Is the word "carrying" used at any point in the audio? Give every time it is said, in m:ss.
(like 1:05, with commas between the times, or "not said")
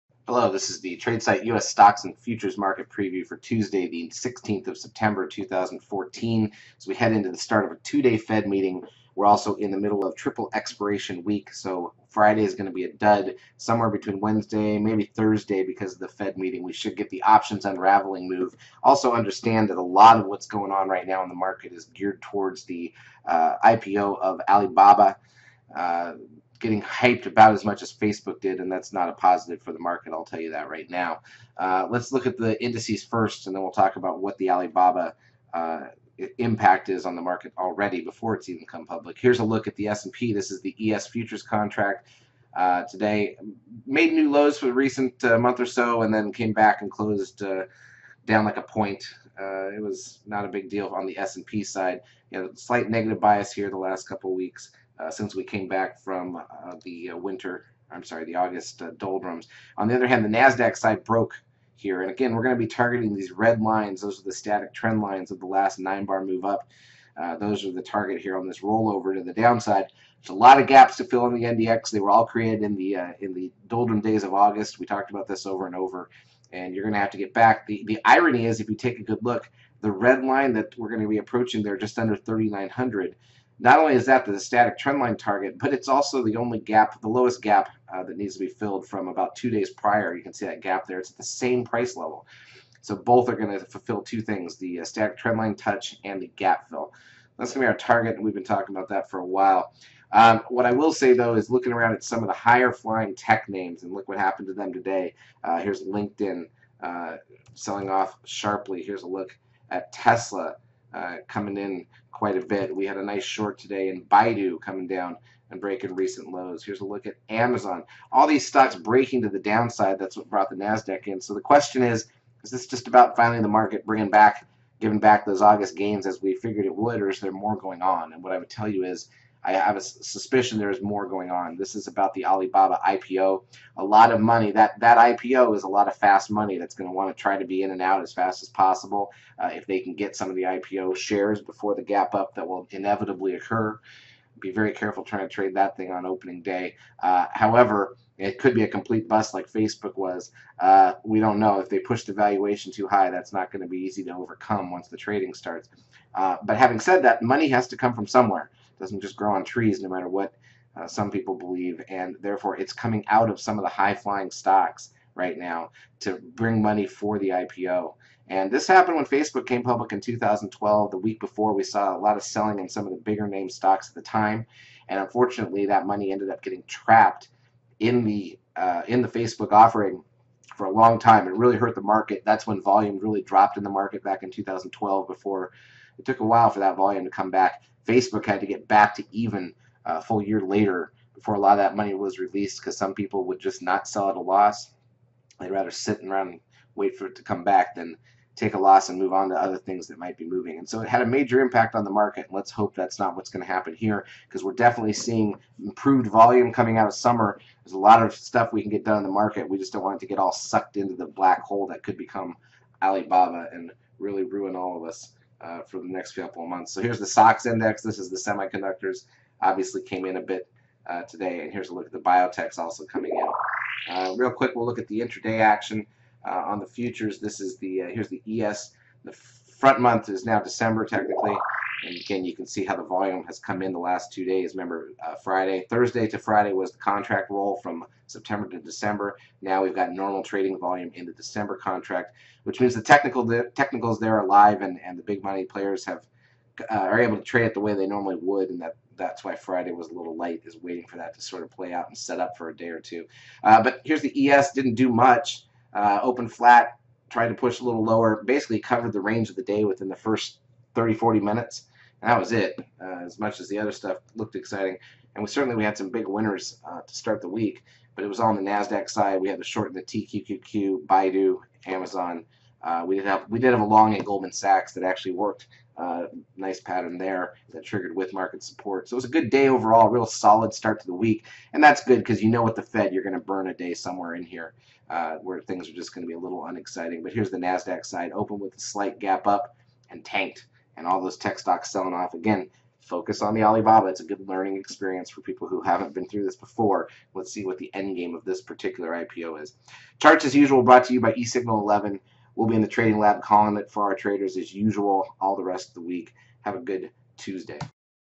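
not said.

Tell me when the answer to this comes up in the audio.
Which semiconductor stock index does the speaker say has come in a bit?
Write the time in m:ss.
3:37.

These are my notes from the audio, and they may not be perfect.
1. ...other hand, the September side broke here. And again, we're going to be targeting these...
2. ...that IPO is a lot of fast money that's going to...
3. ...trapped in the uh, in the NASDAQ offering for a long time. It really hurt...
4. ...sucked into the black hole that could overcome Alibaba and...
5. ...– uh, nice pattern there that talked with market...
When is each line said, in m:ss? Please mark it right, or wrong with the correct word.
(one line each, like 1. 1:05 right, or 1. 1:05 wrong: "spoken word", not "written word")
1. 0:59 wrong: "NASDAQ", not "September"
2. 2:14 right
3. 2:56 wrong: "Facebook", not "NASDAQ"
4. 3:30 wrong: "become", not "overcome"
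5. 4:35 wrong: "triggered", not "talked".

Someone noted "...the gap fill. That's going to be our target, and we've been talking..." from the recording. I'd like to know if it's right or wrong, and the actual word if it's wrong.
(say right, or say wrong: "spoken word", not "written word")
right.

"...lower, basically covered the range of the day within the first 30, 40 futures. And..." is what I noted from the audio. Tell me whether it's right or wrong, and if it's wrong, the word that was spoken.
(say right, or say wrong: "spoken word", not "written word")
wrong: "minutes", not "futures".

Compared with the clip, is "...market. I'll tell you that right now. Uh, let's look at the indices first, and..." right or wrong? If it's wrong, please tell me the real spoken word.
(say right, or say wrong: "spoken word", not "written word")
right.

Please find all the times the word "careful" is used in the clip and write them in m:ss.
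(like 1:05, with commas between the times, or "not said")
2:24.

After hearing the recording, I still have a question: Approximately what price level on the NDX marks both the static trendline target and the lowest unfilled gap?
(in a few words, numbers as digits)
3,900.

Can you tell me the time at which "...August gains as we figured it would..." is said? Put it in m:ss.
2:05.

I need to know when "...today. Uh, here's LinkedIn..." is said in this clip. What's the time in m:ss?
1:44.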